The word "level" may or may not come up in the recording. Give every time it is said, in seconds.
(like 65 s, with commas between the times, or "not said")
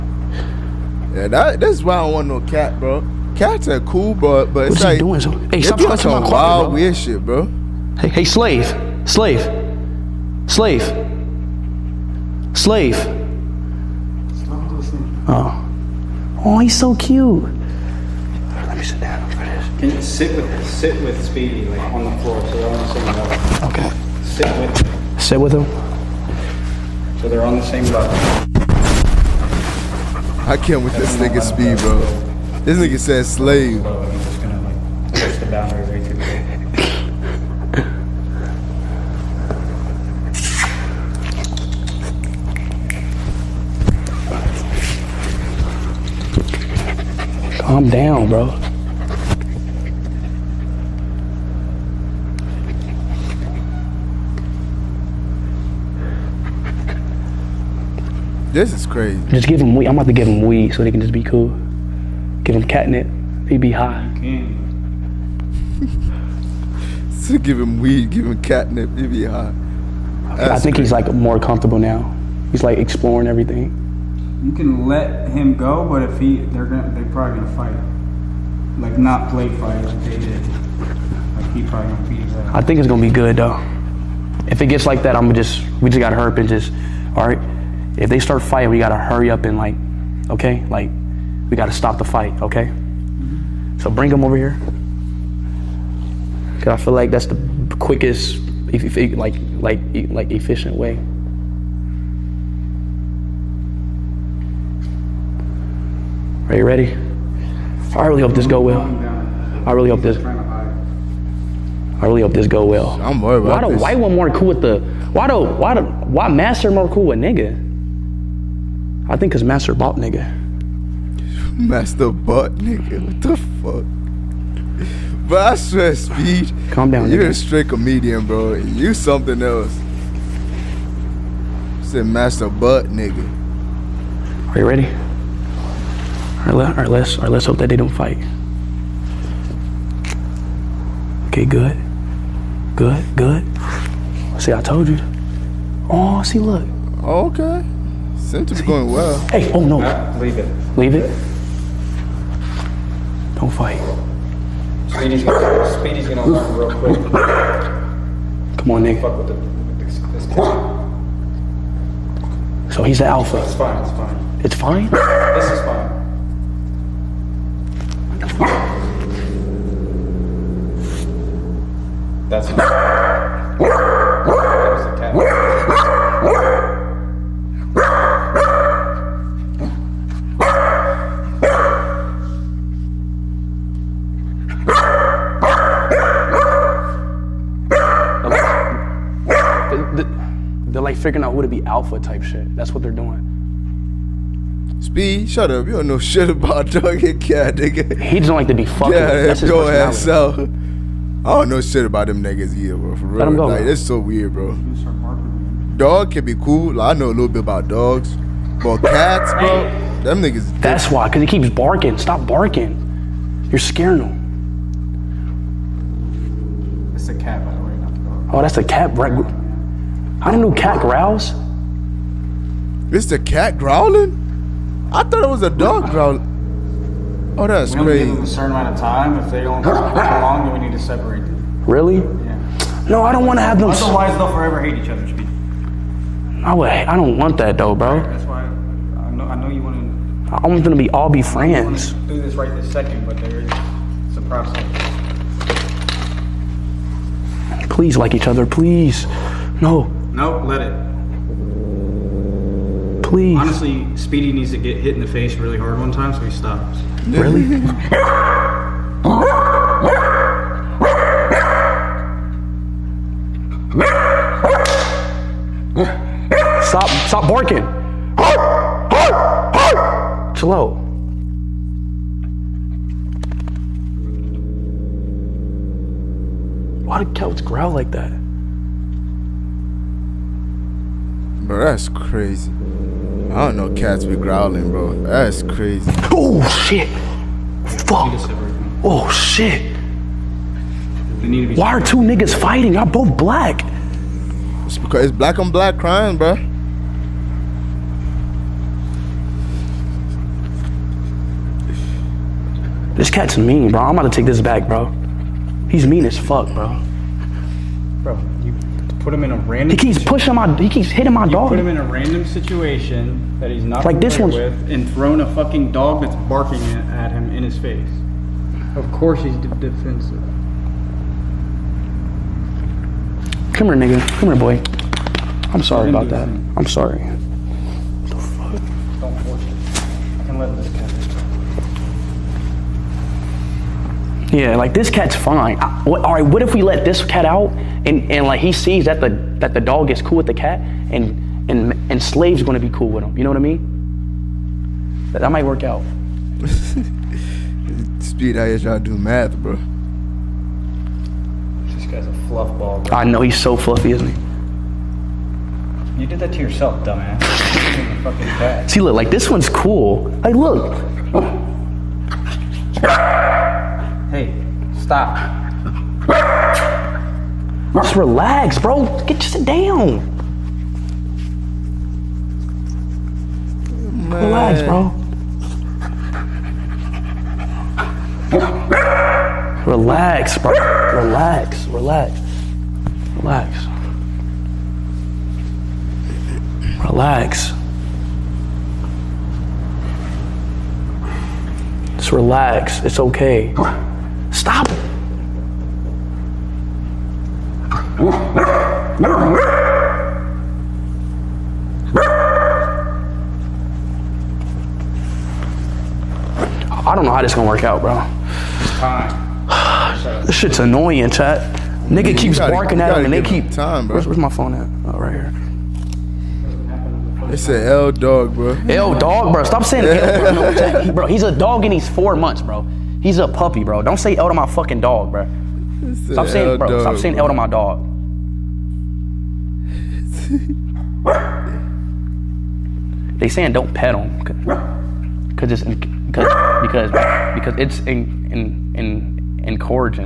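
23 s, 27 s.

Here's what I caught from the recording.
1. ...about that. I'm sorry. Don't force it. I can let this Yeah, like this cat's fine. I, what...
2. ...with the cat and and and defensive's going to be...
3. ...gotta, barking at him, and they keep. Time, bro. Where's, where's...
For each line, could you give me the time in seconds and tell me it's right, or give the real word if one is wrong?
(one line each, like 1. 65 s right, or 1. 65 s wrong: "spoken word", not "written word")
1. 325 s right
2. 340 s wrong: "slave", not "defensive"
3. 412 s right.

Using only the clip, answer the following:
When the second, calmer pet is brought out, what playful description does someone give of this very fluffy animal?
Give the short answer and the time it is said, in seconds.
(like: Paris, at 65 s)
fluff ball, at 352 s.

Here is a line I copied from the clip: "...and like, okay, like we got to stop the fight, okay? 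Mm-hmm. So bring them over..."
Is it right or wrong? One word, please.
right.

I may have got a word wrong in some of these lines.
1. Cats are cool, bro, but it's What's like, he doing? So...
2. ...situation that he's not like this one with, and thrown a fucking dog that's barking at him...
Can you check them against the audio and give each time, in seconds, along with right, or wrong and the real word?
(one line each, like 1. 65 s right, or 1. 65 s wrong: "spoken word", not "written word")
1. 3 s right
2. 312 s right.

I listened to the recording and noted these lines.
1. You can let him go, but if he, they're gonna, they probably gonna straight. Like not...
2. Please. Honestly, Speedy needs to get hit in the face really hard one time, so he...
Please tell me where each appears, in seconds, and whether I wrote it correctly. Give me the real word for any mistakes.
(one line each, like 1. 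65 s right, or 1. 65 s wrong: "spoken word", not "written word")
1. 74 s wrong: "fight", not "straight"
2. 253 s right.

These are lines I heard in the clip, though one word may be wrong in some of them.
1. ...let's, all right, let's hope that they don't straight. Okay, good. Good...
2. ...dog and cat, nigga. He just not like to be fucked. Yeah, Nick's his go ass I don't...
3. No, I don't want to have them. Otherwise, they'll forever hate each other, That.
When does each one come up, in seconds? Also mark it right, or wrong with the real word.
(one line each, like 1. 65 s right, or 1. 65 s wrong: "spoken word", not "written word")
1. 136 s wrong: "fight", not "straight"
2. 196 s wrong: "That", not "Nick"
3. 232 s wrong: "Speed", not "That".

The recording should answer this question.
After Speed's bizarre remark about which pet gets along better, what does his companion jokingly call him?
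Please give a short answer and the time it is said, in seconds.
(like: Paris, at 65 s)
a straight comedian, at 127 s.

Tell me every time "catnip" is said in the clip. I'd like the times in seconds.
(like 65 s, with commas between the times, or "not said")
62 s, 68 s.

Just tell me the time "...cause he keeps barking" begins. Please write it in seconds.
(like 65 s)
211 s.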